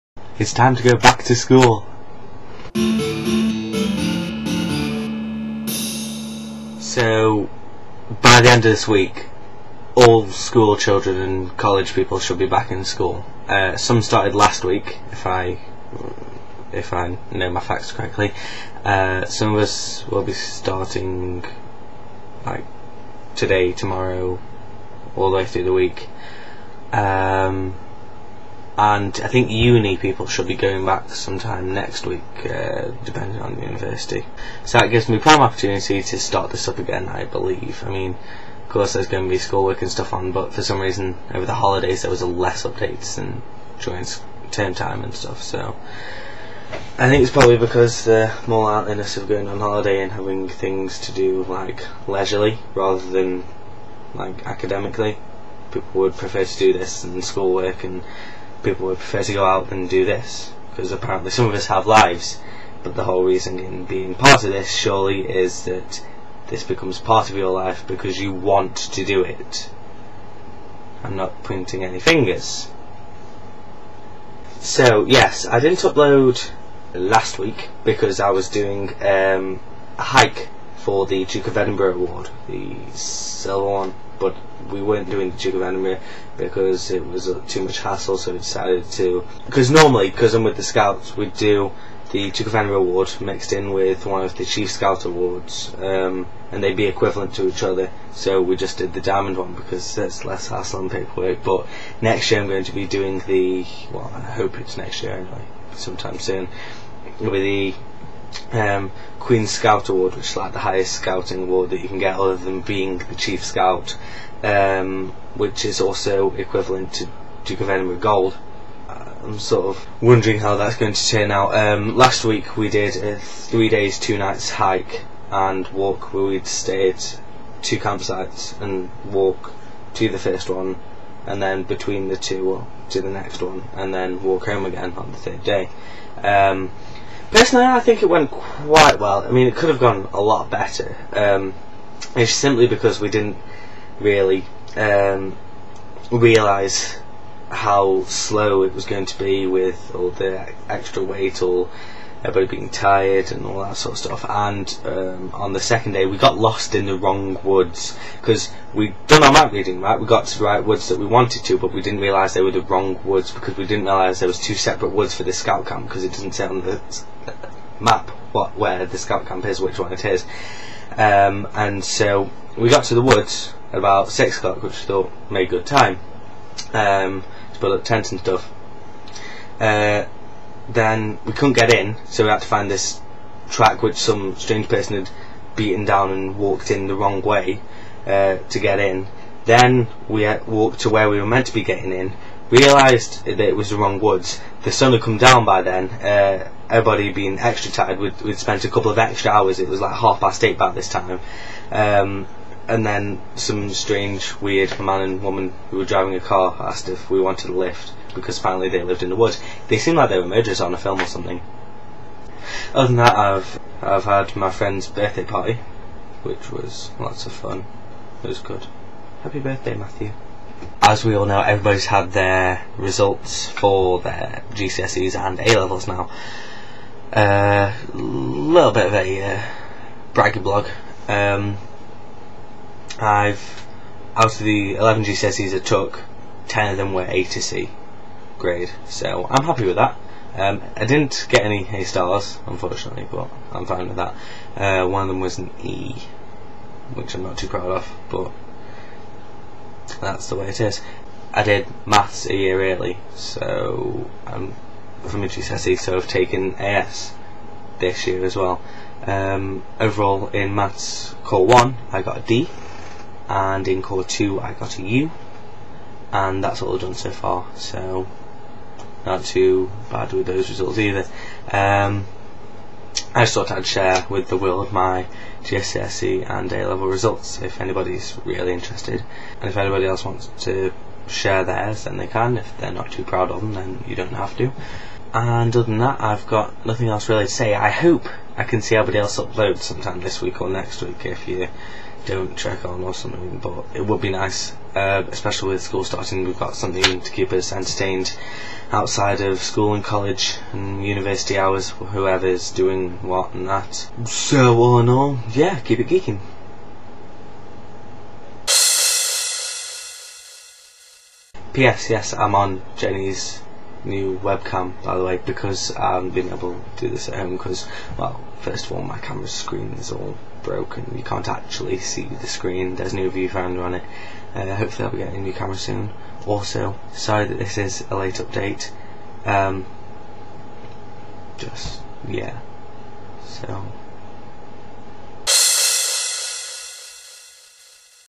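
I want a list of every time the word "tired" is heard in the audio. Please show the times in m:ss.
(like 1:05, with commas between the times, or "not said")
2:32, 3:17.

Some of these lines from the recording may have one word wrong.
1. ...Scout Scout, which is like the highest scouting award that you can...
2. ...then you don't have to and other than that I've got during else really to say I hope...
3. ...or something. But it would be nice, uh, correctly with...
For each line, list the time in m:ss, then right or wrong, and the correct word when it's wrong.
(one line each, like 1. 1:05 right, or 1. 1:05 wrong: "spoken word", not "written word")
1. 1:49 wrong: "Award", not "Scout"
2. 4:43 wrong: "nothing", not "during"
3. 4:52 wrong: "especially", not "correctly".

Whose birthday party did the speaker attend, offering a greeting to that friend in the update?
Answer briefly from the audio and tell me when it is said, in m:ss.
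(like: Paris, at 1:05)
Matthew, at 3:39.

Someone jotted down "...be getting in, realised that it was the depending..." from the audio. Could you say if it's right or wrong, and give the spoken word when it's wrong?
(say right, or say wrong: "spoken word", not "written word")
wrong: "wrong", not "depending".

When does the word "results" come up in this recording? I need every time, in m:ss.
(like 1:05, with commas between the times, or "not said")
3:42, 4:30, 4:36.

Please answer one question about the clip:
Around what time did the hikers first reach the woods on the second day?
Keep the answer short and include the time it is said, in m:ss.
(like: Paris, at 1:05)
6 o'clock, at 2:54.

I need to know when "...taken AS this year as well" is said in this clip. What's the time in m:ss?
4:16.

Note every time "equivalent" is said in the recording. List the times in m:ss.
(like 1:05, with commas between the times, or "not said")
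1:36, 1:56.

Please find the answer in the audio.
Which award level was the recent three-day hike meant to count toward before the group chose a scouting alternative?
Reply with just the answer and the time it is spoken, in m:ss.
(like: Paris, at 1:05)
Silver, at 1:22.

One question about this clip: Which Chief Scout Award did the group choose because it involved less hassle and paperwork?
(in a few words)
Diamond.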